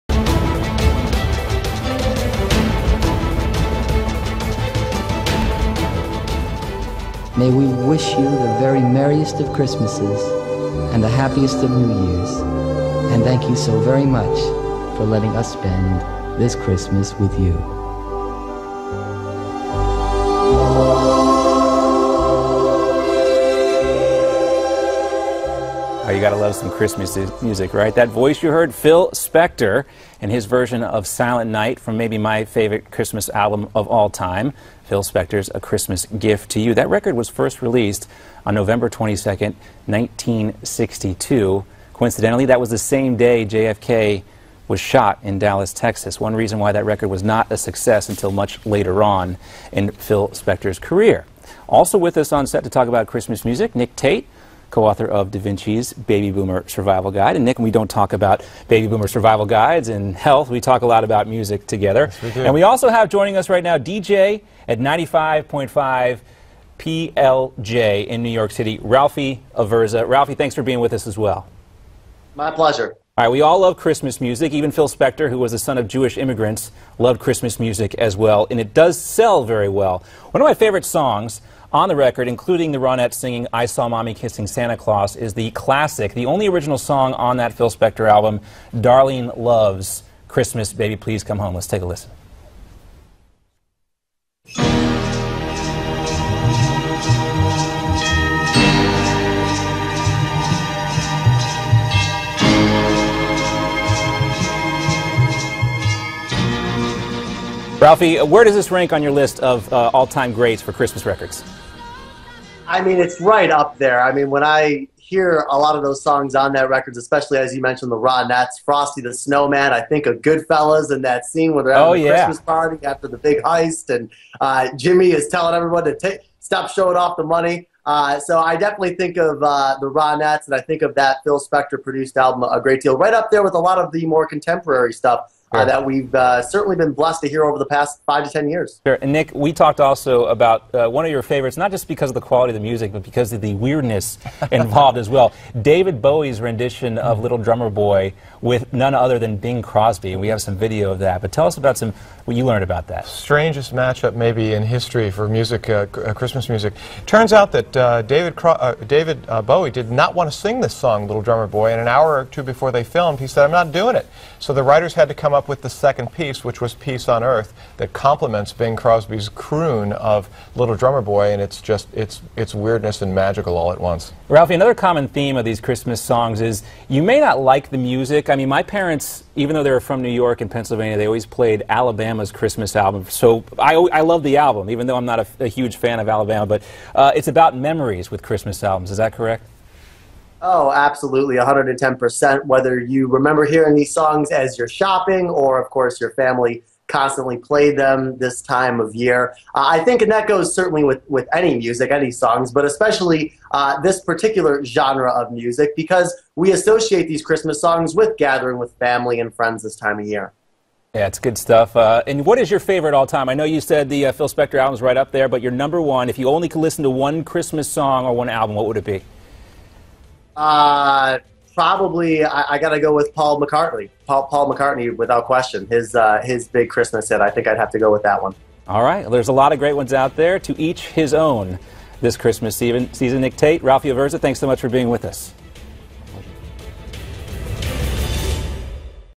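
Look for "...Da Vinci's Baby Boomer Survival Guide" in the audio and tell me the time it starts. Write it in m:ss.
0:55.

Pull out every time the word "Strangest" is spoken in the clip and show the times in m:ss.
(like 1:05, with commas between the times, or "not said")
2:33.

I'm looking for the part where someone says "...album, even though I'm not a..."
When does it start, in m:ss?
3:04.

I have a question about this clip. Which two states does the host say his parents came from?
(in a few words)
New York and Pennsylvania.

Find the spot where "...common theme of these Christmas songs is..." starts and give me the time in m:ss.
2:54.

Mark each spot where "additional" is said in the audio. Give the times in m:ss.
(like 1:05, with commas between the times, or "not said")
not said.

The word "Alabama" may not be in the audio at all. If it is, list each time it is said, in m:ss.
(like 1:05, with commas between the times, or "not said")
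3:01, 3:06.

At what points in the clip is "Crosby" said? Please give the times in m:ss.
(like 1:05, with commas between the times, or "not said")
2:29, 2:48.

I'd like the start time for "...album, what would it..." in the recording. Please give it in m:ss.
3:38.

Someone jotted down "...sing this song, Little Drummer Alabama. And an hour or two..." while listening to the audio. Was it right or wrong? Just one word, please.
wrong.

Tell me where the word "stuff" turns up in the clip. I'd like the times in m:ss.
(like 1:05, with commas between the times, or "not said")
2:14, 3:31.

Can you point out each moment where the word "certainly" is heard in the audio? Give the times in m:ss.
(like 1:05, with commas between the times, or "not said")
2:16, 3:20.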